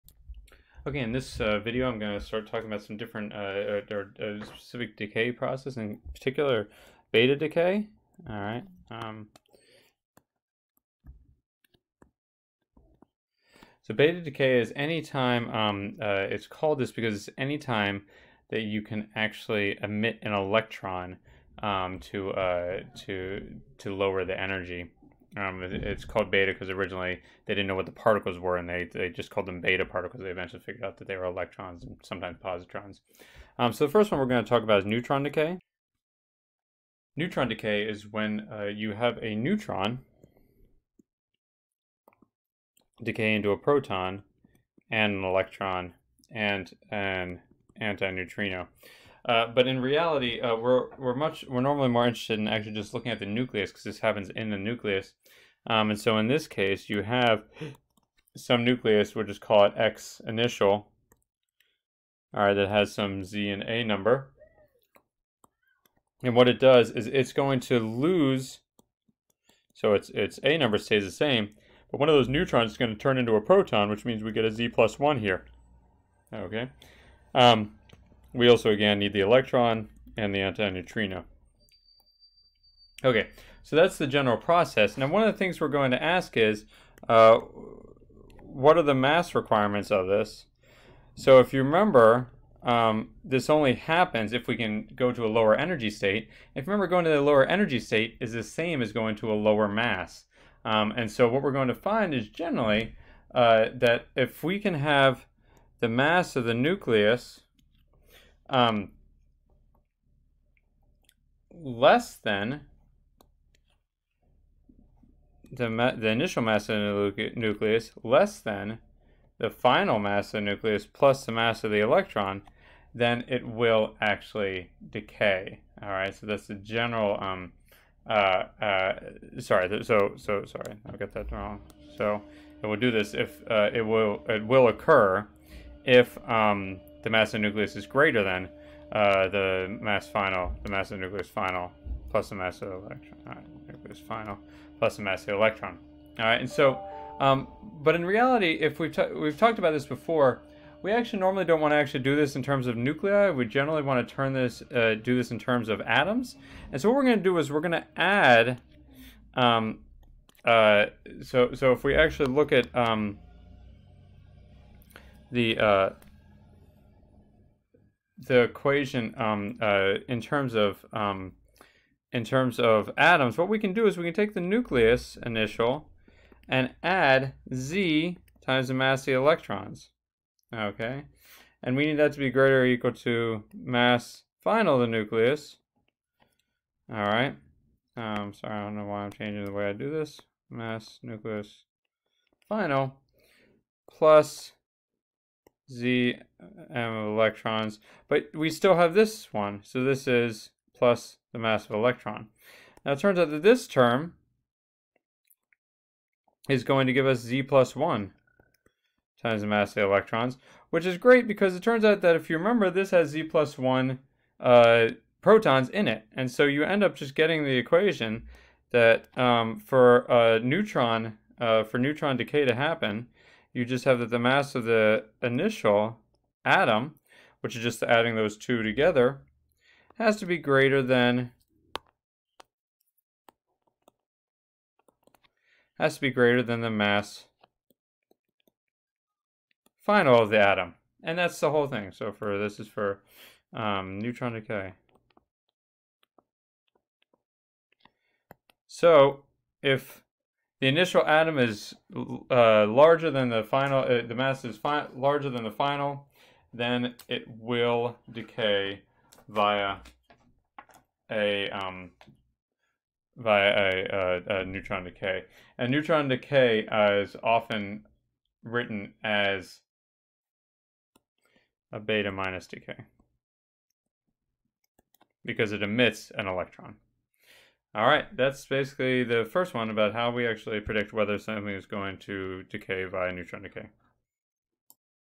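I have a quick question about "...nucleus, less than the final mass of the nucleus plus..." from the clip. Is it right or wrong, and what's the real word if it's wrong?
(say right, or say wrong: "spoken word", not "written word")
right.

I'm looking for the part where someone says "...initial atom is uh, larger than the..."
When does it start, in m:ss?
4:10.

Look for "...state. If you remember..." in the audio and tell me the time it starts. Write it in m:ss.
1:35.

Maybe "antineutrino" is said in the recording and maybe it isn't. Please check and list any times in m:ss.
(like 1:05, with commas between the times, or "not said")
0:47, 1:20.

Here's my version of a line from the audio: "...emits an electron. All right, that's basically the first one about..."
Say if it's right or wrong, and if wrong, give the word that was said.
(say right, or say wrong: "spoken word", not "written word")
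right.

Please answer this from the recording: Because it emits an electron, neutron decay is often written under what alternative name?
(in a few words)
beta minus decay.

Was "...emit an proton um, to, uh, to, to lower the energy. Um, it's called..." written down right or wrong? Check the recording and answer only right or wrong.
wrong.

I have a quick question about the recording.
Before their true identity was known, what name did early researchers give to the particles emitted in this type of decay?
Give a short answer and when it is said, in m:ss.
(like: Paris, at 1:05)
beta particles, at 0:29.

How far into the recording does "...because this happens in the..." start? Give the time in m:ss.
0:53.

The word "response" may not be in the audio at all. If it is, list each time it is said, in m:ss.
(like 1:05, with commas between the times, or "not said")
not said.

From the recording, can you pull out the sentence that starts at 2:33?
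We generally want to turn this, uh, do this in terms of atoms.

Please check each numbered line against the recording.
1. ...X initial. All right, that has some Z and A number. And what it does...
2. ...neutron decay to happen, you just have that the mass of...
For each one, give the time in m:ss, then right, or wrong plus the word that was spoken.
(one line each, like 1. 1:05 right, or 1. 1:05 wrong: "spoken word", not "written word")
1. 0:59 right
2. 3:41 right.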